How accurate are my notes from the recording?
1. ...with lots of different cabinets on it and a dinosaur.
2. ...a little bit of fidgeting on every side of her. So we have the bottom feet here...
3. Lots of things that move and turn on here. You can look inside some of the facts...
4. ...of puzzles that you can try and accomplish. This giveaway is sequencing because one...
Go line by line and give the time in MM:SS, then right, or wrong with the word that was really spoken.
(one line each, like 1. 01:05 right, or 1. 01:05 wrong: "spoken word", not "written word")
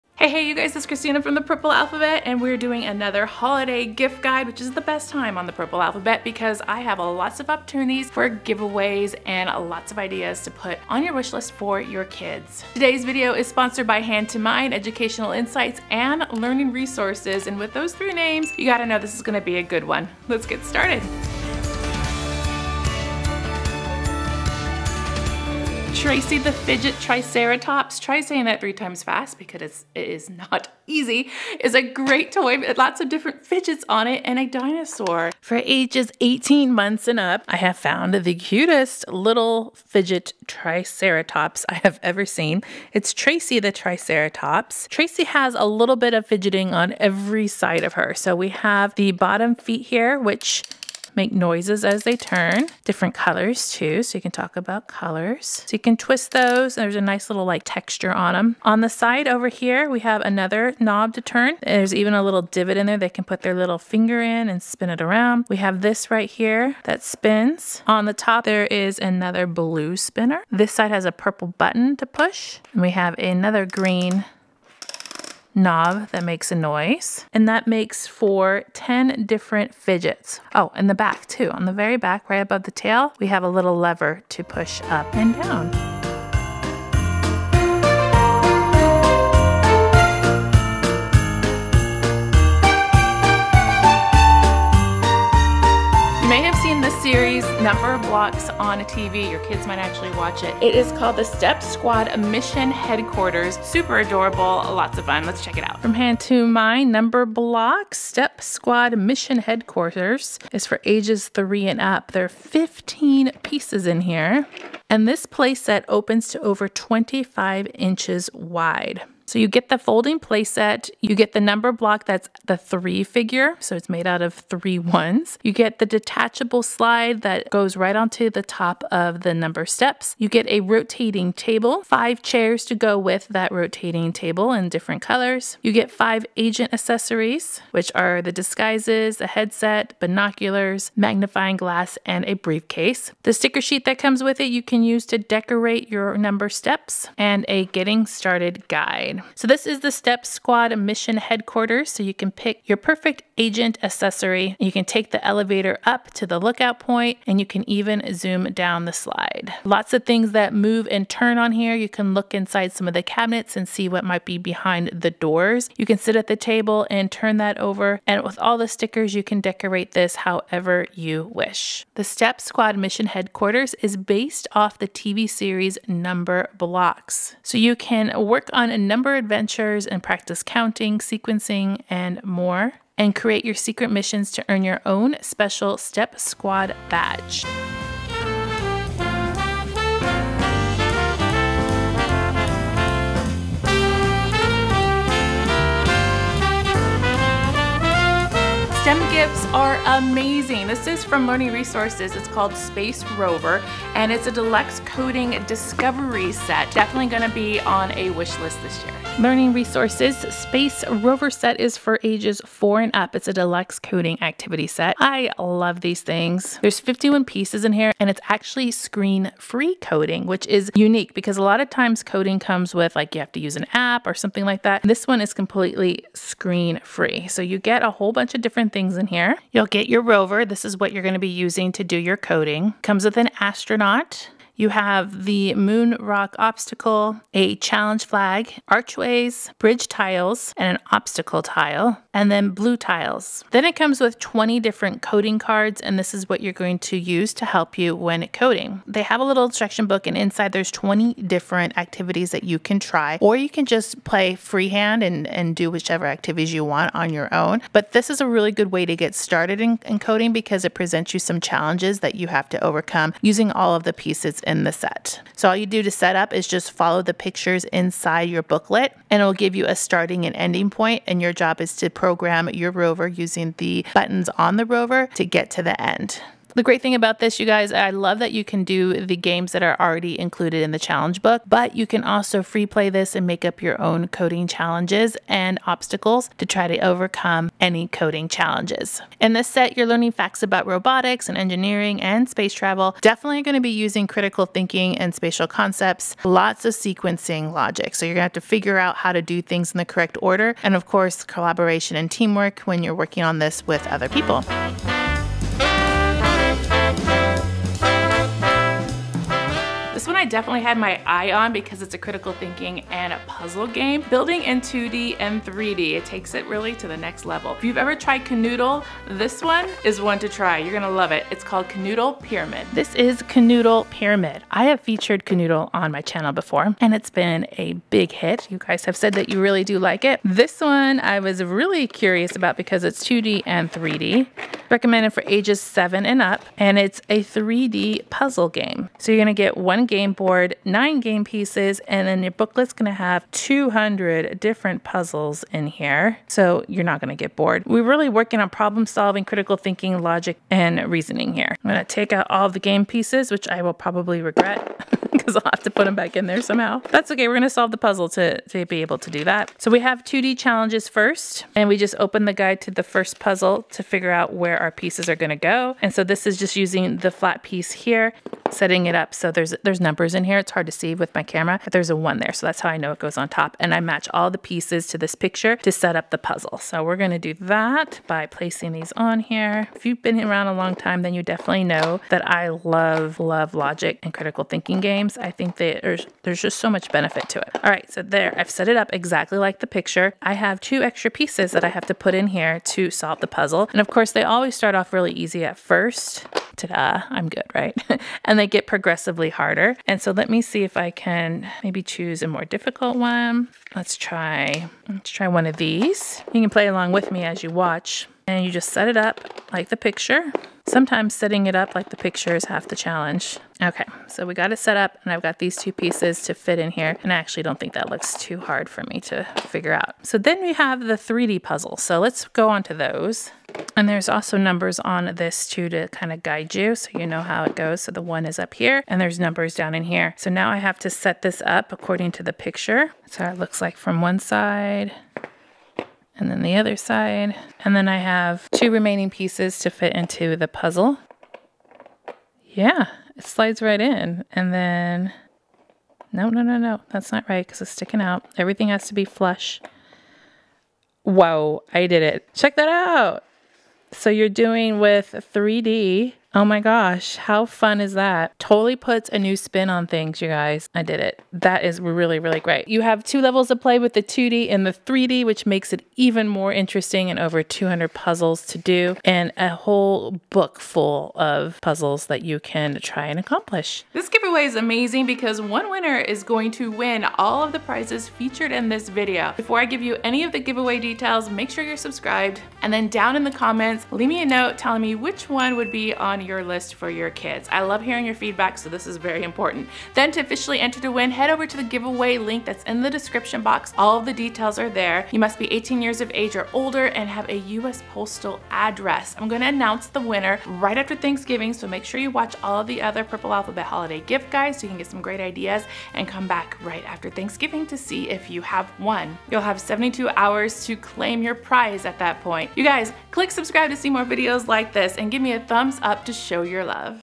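1. 00:32 wrong: "fidgets", not "cabinets"
2. 00:45 right
3. 02:39 wrong: "cabinets", not "facts"
4. 07:51 wrong: "amazing", not "sequencing".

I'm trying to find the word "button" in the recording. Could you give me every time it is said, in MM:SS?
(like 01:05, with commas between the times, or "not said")
01:11, 04:33.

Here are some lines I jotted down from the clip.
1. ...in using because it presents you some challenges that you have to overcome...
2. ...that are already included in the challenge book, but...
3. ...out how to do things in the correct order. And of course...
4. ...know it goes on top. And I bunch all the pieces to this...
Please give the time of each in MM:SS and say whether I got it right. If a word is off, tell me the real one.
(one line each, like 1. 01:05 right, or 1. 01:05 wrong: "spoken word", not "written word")
1. 04:19 wrong: "coding", not "using"
2. 04:39 right
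3. 04:58 right
4. 06:12 wrong: "match", not "bunch".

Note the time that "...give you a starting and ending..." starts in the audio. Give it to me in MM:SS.
04:29.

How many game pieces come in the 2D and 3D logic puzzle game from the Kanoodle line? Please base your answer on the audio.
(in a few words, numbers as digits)
9.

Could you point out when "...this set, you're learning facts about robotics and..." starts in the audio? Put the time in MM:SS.
04:49.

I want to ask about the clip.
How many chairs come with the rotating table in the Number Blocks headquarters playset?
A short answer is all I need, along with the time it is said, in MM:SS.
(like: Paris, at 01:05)
5, at 02:11.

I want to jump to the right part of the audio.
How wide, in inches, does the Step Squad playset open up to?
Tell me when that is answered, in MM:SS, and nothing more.
01:56.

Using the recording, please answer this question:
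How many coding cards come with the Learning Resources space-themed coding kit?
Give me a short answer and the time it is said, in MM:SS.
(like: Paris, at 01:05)
20, at 04:04.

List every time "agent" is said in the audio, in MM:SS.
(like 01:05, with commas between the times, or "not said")
02:16, 02:33.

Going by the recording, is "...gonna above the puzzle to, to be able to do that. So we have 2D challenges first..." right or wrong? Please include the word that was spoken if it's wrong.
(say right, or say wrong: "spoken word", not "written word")
wrong: "solve", not "above".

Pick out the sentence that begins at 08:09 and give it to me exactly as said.
Then to officially enter to win, head over to the giveaway link that's in the description box.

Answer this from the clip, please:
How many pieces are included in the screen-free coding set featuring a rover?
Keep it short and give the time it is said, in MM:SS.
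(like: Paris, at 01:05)
51, at 03:36.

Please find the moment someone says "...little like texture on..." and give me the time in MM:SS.
00:57.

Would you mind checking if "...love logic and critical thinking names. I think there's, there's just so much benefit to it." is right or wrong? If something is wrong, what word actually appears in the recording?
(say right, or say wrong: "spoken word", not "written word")
wrong: "games", not "names".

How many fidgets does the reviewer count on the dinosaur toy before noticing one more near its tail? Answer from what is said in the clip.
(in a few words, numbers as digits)
10.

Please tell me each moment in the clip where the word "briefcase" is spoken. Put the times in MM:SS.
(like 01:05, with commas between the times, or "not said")
02:22.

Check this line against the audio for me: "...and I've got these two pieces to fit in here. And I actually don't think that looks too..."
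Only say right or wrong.
right.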